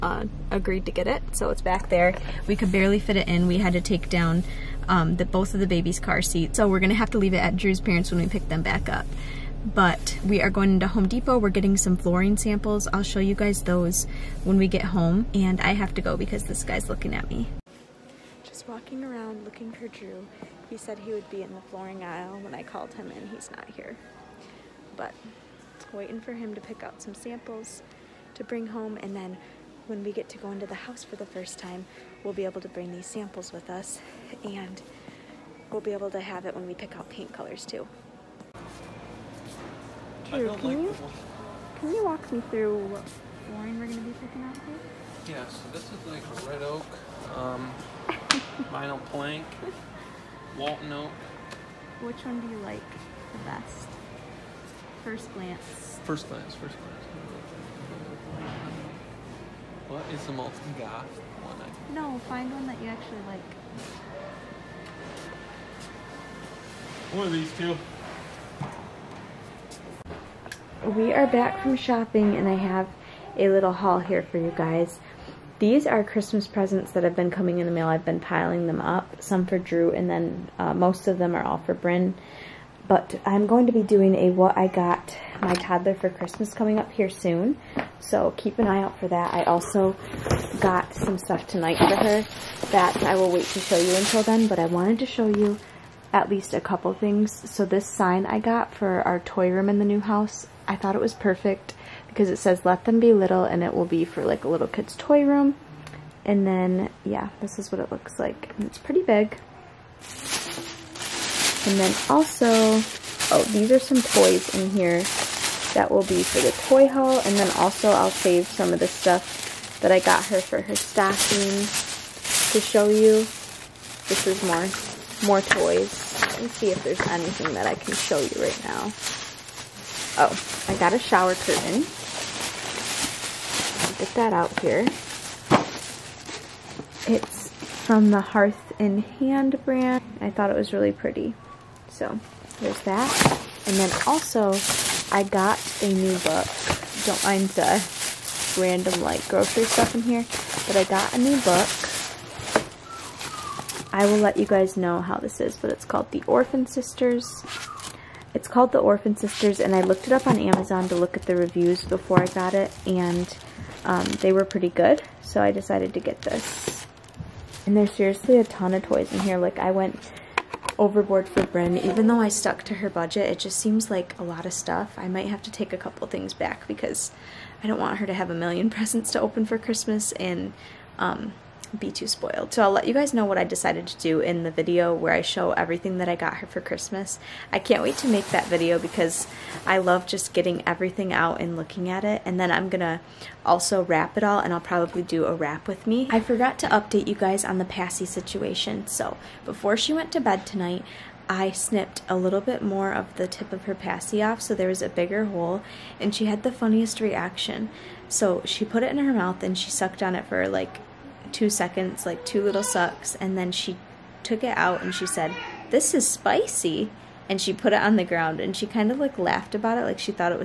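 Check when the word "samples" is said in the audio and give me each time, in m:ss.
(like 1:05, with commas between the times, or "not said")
0:12, 0:27, 0:33.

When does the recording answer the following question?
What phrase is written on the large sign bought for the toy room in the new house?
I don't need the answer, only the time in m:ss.
1:42.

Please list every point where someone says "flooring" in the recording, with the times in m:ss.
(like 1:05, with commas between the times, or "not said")
0:11, 0:21, 0:43.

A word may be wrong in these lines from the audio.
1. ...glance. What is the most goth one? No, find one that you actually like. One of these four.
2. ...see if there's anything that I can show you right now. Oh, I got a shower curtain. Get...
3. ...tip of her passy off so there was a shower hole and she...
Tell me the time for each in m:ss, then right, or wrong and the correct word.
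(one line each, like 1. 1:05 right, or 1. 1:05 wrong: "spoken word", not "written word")
1. 0:56 wrong: "two", not "four"
2. 2:06 right
3. 3:23 wrong: "bigger", not "shower".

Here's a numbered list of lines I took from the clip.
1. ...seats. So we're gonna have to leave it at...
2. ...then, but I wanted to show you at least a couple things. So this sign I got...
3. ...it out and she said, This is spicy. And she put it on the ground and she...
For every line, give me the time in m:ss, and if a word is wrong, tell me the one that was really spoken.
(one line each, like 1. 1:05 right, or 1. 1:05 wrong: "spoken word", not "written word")
1. 0:06 right
2. 1:34 right
3. 3:34 right.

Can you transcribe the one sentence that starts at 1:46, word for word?
And then, yeah, this is what it looks like.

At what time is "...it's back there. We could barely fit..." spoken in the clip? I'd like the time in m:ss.
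0:01.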